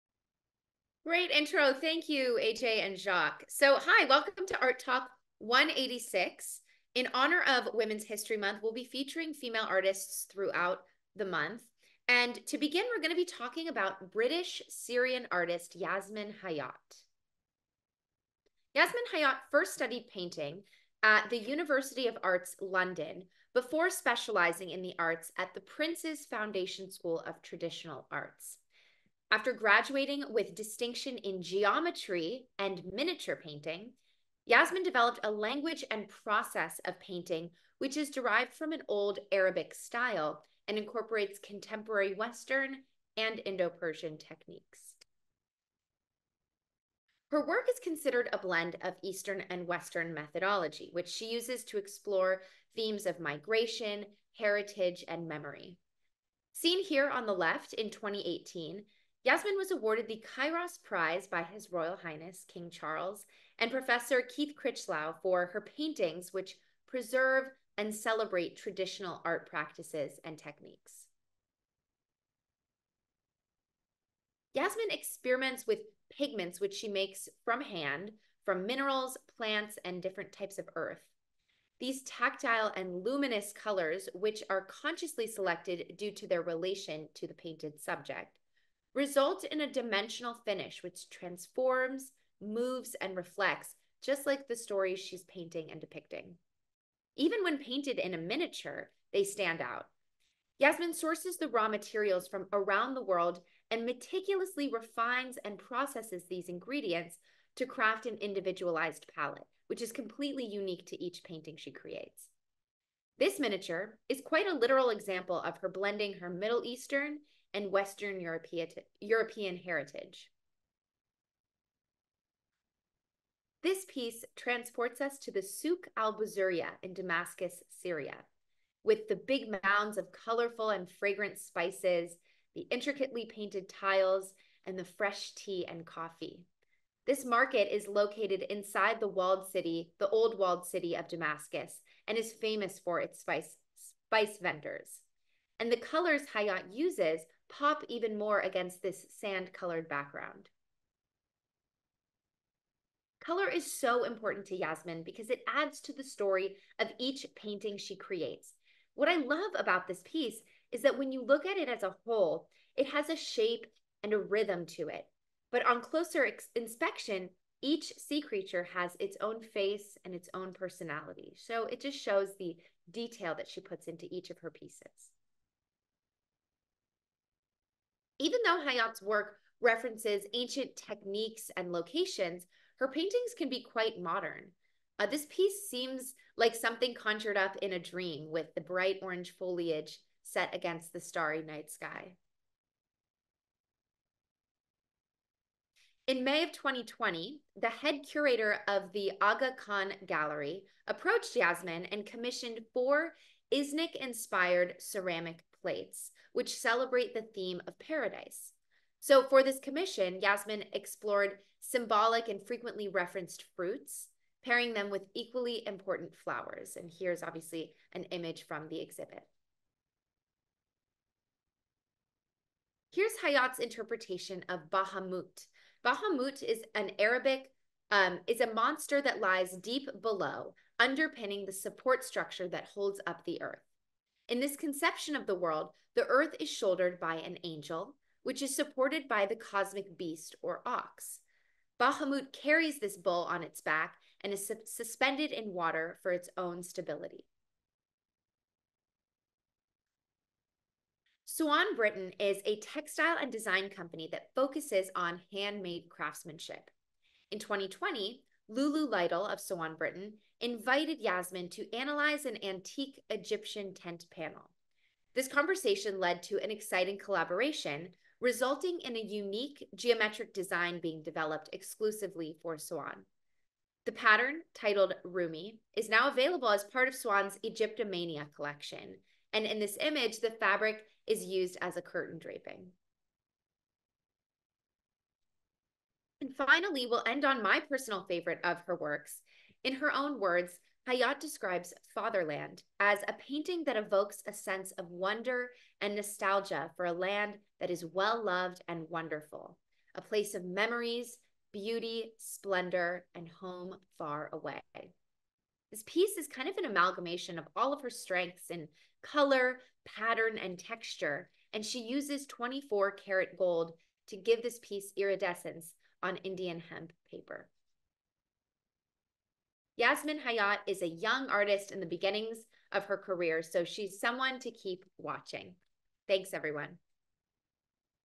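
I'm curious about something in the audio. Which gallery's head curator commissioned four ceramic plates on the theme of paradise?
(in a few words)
Aga Khan Gallery.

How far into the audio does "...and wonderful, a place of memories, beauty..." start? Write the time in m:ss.
4:58.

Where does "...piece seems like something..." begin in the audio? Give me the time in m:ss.
3:05.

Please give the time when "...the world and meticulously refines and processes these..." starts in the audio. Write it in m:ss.
1:42.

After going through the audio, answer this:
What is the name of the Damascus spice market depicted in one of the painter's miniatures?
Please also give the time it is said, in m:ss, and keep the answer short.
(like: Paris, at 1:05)
Souk al Buzuria, at 2:05.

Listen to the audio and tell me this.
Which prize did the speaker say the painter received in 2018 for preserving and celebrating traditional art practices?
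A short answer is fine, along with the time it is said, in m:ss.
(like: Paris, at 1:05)
Kairos Prize, at 1:00.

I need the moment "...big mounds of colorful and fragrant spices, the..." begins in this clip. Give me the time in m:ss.
2:09.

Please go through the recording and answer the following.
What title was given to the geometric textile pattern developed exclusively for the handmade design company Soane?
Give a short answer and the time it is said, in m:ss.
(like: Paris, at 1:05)
Rumi, at 4:35.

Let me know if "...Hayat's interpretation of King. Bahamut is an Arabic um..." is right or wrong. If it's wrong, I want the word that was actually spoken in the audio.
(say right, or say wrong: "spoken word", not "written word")
wrong: "Bahamut", not "King".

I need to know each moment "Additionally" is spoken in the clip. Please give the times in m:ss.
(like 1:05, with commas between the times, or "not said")
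not said.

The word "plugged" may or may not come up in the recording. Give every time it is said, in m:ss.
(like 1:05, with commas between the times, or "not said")
not said.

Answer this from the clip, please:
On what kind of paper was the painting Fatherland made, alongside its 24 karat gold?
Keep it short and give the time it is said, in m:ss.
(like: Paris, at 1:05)
Indian hemp paper, at 5:16.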